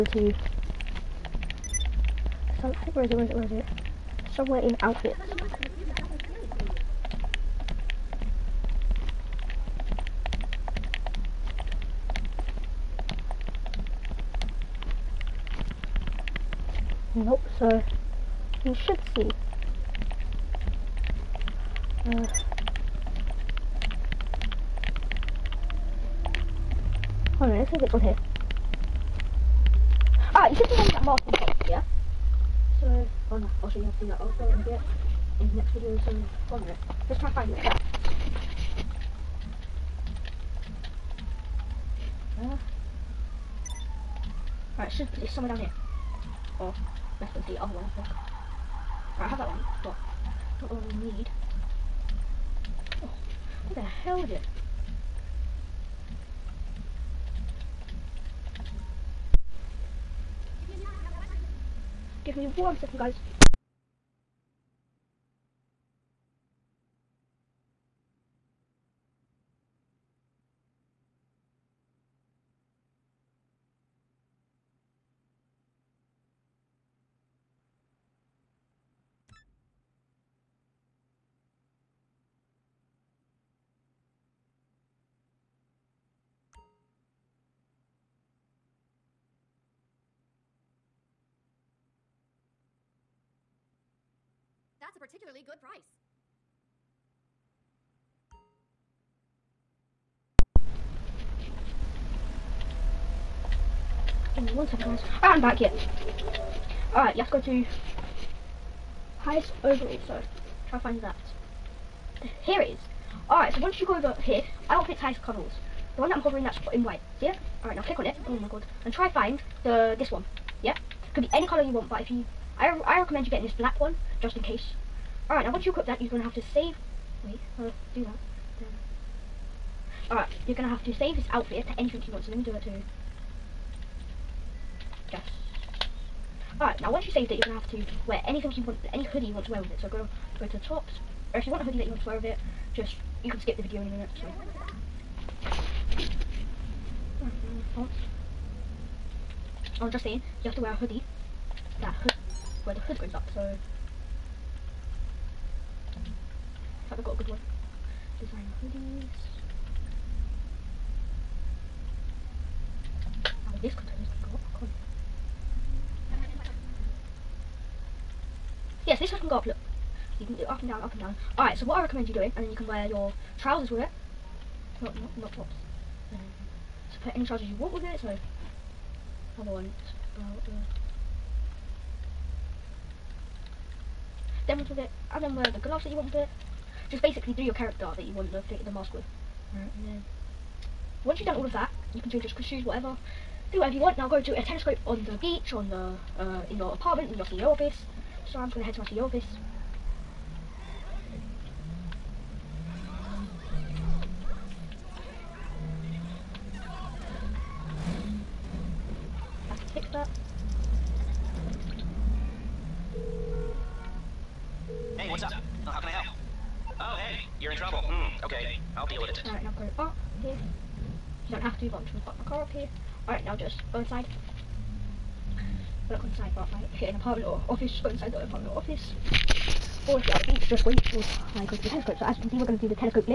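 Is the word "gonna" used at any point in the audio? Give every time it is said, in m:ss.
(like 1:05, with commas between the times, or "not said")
3:18, 3:41.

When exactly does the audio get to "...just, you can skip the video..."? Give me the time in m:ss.
2:22.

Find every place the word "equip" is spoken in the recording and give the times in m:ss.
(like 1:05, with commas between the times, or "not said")
2:05.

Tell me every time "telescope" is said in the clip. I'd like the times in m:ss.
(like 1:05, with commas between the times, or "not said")
3:14, 3:51.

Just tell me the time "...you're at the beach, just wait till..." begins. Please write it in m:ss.
3:50.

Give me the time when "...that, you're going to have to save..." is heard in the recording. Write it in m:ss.
2:05.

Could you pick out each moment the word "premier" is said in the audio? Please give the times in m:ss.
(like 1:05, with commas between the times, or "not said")
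not said.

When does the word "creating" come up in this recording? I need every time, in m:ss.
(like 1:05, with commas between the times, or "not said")
not said.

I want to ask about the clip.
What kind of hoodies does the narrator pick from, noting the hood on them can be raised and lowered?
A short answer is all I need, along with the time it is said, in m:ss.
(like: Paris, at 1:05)
Designer hoodies, at 2:38.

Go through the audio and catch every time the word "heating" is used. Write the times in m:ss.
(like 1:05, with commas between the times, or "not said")
not said.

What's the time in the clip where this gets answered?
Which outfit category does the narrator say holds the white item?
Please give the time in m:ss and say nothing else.
1:49.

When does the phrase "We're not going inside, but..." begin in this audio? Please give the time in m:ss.
3:45.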